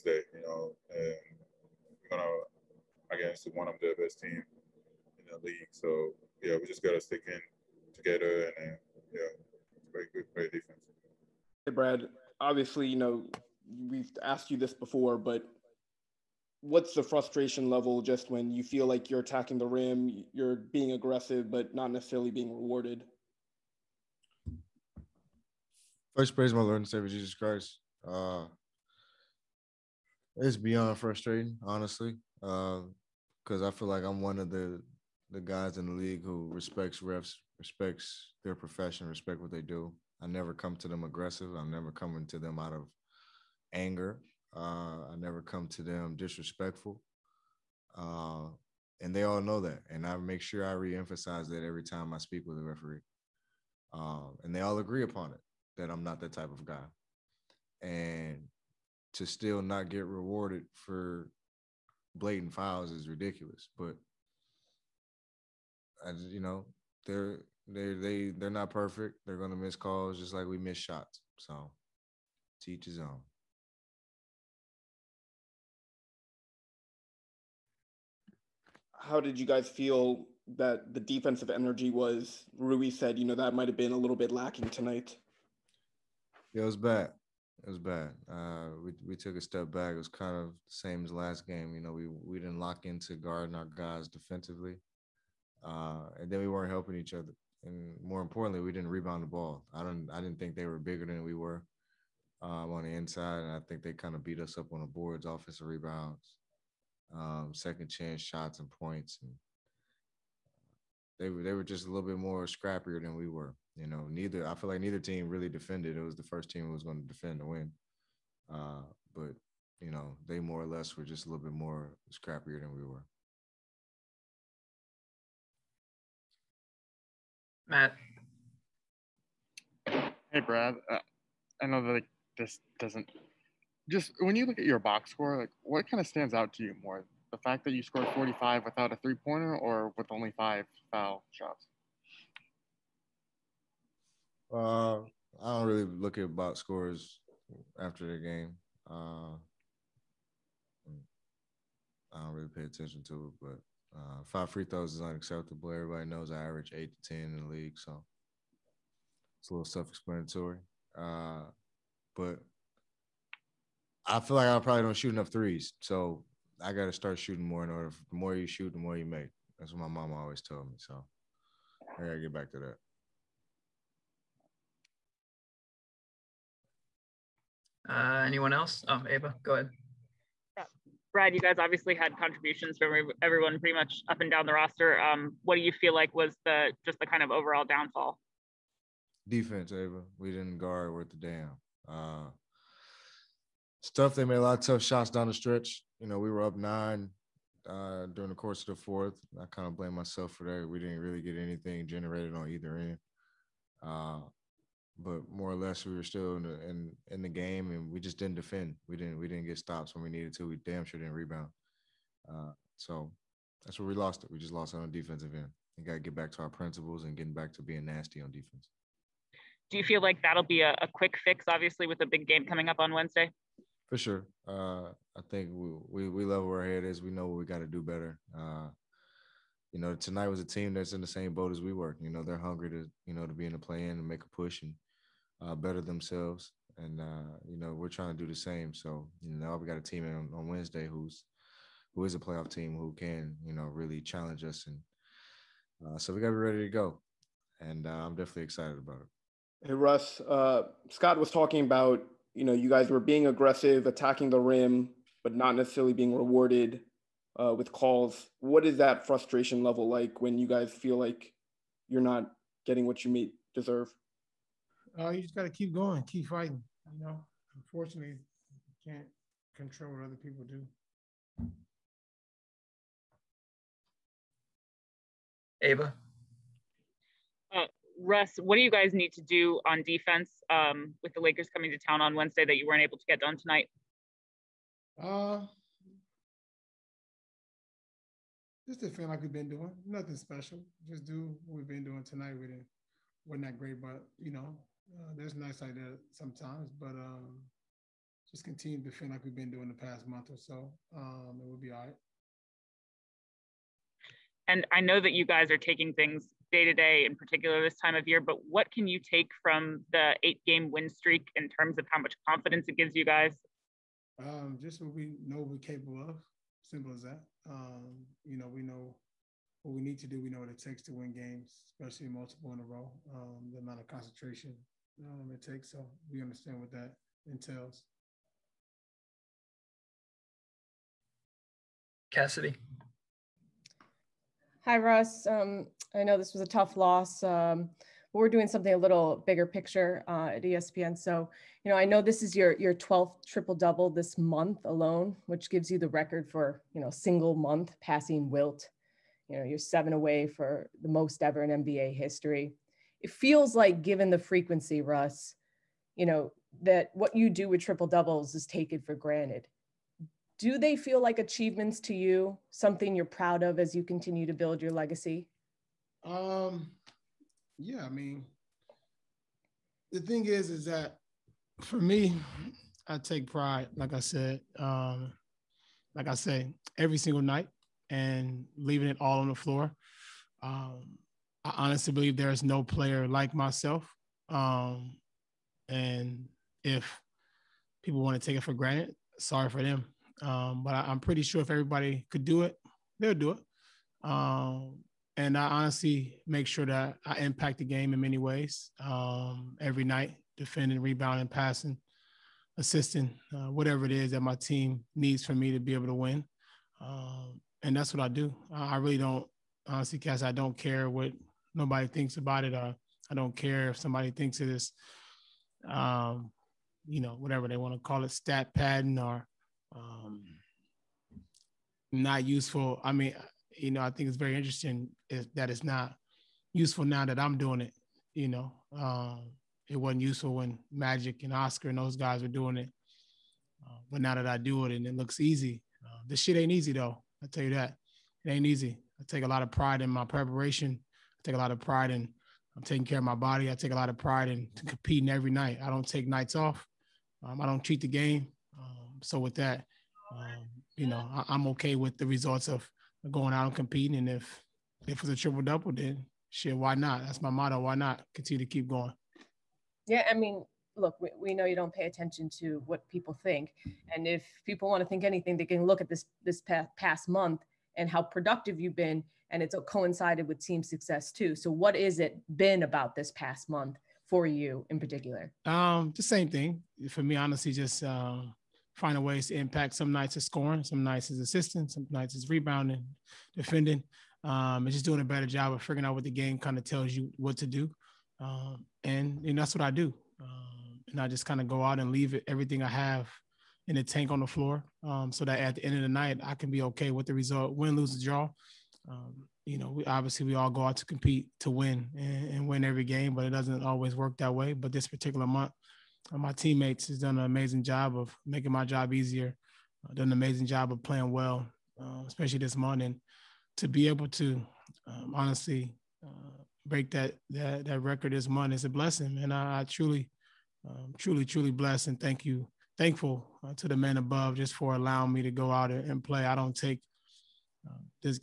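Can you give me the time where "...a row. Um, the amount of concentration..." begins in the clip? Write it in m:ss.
5:22.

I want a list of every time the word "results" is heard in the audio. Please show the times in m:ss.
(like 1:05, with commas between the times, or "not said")
7:32, 8:17.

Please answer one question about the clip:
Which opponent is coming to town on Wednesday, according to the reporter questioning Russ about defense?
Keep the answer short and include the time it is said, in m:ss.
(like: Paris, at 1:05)
Lakers, at 4:41.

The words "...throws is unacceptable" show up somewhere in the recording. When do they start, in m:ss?
2:34.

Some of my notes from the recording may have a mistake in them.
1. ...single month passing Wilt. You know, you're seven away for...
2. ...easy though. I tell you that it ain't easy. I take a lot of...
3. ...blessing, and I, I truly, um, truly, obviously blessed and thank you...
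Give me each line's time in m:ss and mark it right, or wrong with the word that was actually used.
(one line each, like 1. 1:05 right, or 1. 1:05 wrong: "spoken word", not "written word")
1. 5:46 right
2. 7:16 right
3. 8:38 wrong: "truly", not "obviously".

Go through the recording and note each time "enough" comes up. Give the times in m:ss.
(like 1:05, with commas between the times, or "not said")
2:45.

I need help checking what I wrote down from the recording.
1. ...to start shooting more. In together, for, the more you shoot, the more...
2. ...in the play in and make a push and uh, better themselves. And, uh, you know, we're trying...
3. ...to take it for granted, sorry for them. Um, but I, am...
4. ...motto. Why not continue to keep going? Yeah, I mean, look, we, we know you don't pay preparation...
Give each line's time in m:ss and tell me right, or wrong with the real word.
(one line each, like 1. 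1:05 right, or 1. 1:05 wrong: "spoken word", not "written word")
1. 2:46 wrong: "order", not "together"
2. 3:53 right
3. 6:28 right
4. 7:37 wrong: "attention", not "preparation".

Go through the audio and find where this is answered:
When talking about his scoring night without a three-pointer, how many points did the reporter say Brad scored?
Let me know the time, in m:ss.
2:18.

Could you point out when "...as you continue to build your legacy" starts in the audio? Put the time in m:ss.
6:03.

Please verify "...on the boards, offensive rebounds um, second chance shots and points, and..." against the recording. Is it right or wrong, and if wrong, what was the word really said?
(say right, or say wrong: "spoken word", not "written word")
right.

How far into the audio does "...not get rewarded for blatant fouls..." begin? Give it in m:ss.
0:59.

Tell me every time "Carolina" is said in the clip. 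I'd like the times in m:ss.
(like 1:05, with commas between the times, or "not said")
not said.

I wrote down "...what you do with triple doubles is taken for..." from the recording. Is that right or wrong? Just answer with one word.
right.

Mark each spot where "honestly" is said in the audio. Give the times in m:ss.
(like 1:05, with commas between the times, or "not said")
0:31, 6:21, 6:35, 6:49, 7:57, 8:35.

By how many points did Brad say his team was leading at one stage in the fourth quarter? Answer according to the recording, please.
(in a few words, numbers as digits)
9.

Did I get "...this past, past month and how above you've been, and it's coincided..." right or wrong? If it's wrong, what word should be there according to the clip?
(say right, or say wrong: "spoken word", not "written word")
wrong: "productive", not "above".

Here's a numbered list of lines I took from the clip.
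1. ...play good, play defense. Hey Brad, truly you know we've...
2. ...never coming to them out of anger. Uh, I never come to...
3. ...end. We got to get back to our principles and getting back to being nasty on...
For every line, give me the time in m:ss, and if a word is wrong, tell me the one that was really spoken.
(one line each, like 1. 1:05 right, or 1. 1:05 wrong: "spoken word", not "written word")
1. 0:09 wrong: "obviously", not "truly"
2. 0:41 right
3. 3:35 right.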